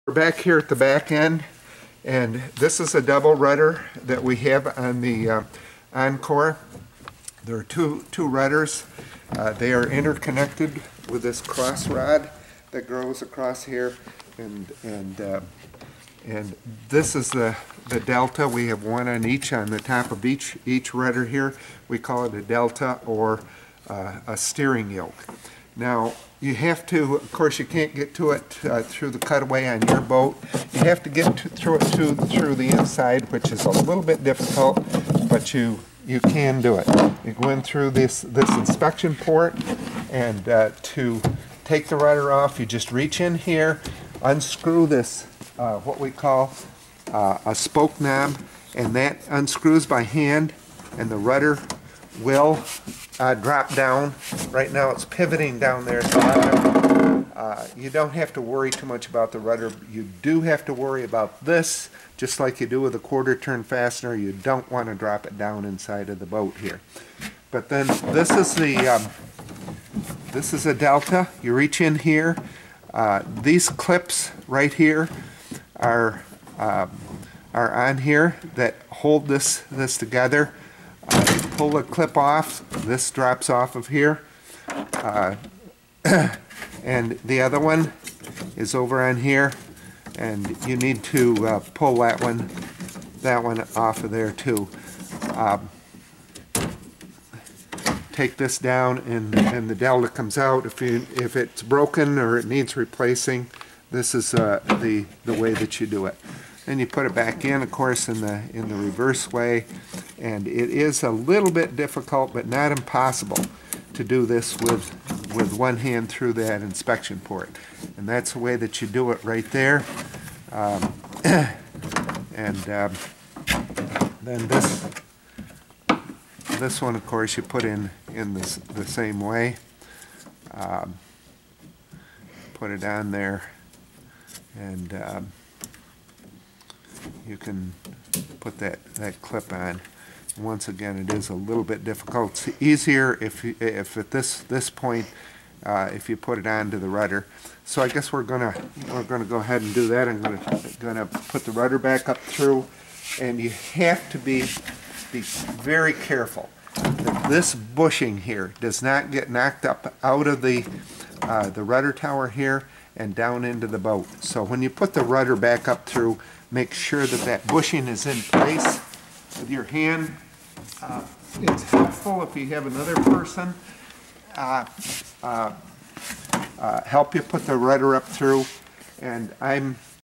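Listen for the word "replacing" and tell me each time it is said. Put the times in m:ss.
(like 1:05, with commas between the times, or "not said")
1:42.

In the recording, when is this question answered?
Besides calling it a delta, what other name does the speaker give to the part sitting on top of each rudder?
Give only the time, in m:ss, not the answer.
0:24.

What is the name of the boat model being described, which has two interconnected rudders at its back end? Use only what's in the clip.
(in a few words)
Encore.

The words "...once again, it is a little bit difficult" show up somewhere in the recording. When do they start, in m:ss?
2:20.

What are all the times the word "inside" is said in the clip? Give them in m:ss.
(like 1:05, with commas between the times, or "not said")
0:32, 1:05.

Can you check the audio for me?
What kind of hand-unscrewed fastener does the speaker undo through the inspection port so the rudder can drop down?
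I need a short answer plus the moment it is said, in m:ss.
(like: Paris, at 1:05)
Spoke knob, at 0:47.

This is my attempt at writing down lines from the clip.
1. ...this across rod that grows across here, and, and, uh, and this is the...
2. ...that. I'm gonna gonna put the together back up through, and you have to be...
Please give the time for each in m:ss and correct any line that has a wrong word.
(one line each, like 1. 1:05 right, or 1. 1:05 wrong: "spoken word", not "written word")
1. 0:11 wrong: "cross", not "across"
2. 2:29 wrong: "rudder", not "together".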